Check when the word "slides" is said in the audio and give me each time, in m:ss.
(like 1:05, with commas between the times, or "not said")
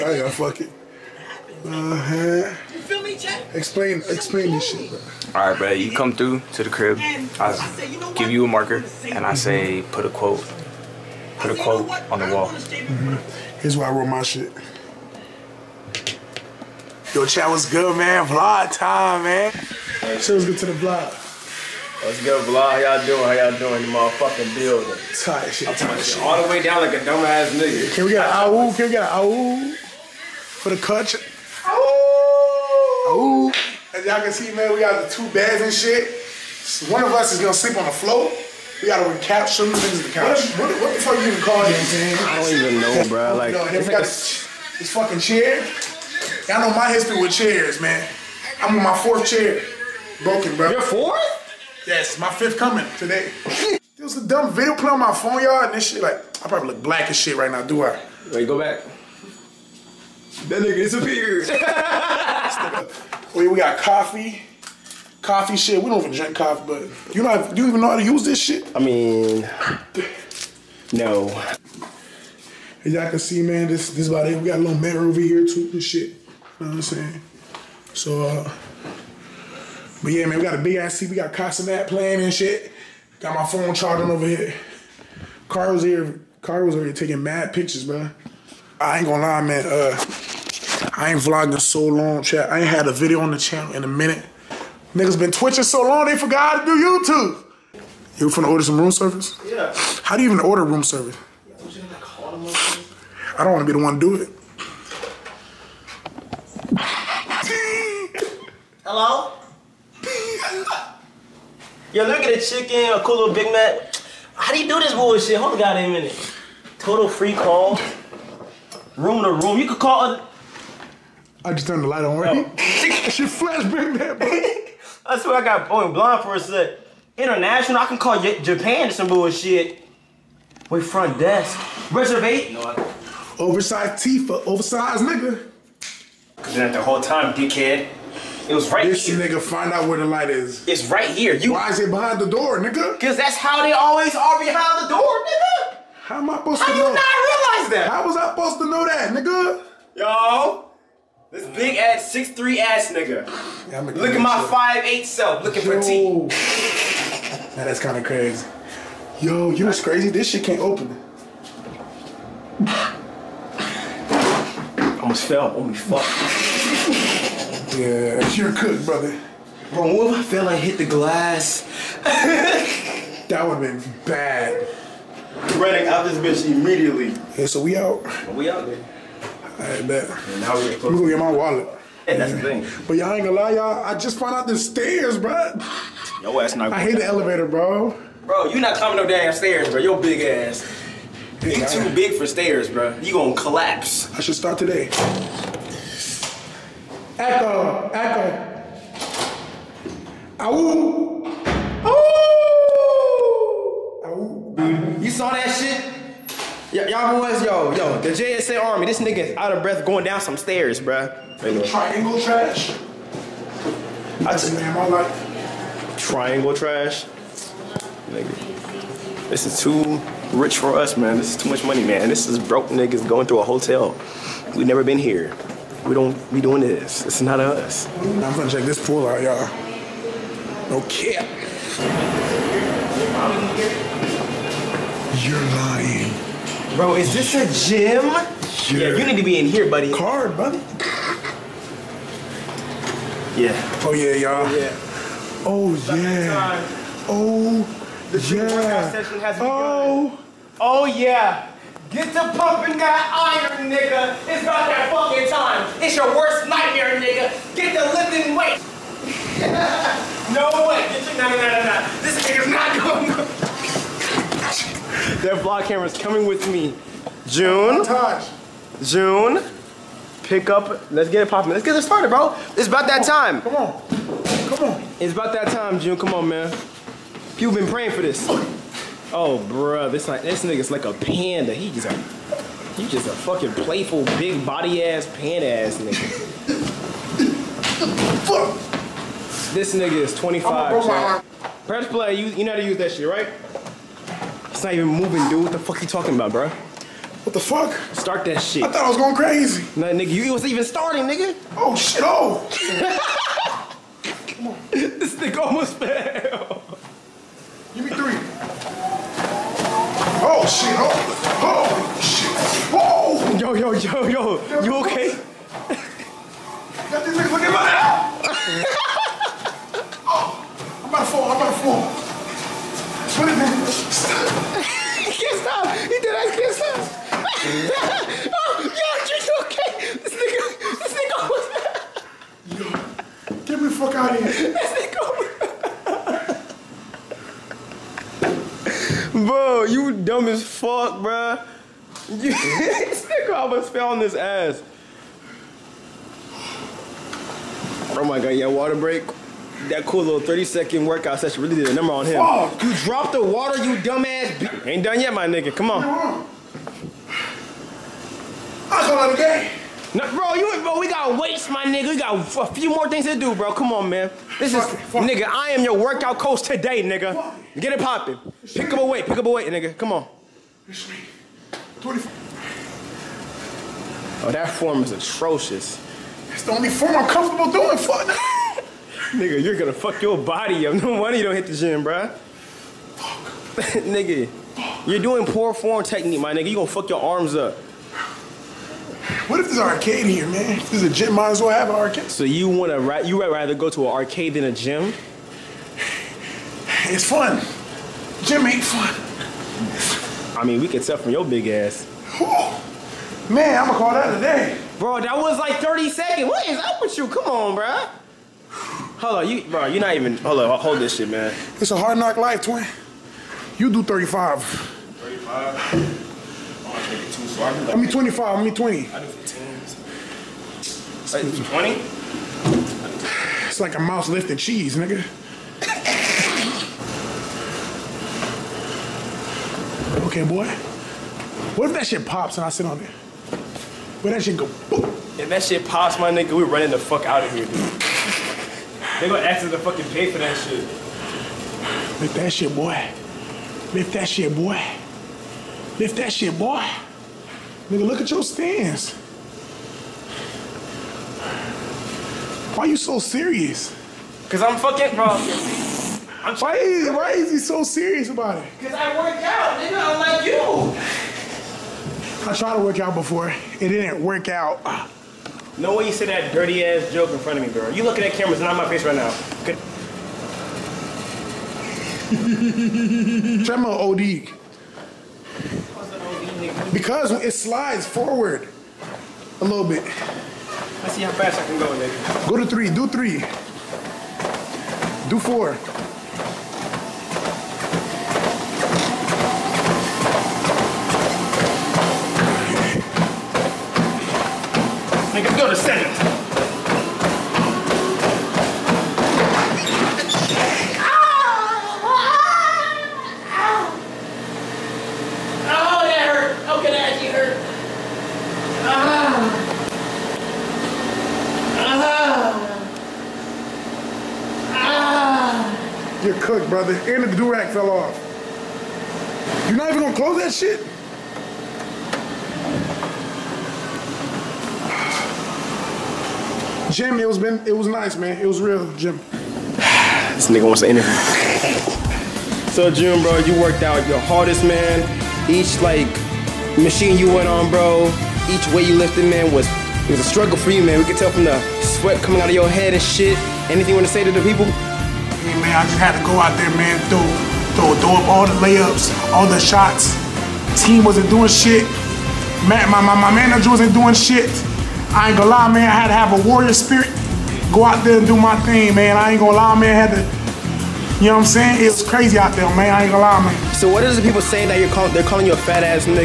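7:57.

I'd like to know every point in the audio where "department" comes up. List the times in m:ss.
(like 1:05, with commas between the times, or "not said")
not said.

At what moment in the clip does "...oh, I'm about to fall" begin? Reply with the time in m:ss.
5:20.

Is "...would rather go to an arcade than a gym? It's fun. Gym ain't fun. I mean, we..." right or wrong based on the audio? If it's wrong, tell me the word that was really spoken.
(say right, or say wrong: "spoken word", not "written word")
right.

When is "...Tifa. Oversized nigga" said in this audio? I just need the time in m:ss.
2:14.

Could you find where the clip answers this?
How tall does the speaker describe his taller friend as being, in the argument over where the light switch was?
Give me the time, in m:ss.
2:32.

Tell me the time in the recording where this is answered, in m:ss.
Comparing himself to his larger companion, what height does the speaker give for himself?
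2:34.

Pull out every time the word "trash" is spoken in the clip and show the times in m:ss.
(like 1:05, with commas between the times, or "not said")
3:32, 3:36.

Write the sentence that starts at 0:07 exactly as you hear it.
I give you a marker, and I mm-hmm.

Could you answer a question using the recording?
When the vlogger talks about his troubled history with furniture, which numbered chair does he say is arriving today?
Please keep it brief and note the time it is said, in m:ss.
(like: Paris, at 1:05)
fifth, at 0:52.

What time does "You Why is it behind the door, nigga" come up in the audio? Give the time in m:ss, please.
2:21.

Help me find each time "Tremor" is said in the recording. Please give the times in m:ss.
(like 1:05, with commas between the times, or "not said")
7:53.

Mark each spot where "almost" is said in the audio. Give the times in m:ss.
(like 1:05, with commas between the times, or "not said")
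2:45, 5:05, 5:43.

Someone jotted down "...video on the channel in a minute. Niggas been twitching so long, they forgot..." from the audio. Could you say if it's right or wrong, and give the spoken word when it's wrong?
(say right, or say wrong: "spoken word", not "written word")
right.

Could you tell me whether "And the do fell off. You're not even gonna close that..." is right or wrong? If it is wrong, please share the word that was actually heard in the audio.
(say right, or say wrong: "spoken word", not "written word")
right.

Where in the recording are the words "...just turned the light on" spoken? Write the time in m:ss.
2:01.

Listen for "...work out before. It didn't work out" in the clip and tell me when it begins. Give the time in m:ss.
7:42.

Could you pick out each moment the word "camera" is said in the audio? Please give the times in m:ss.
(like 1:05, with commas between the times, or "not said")
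4:25, 7:48.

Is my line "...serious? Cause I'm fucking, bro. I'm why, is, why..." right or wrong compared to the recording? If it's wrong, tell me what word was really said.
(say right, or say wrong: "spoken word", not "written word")
right.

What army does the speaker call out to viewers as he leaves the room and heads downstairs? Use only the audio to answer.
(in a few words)
JSA Army.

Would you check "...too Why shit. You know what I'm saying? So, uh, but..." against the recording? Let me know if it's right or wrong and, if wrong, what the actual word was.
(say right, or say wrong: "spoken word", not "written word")
wrong: "This", not "Why".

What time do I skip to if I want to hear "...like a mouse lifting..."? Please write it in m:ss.
7:03.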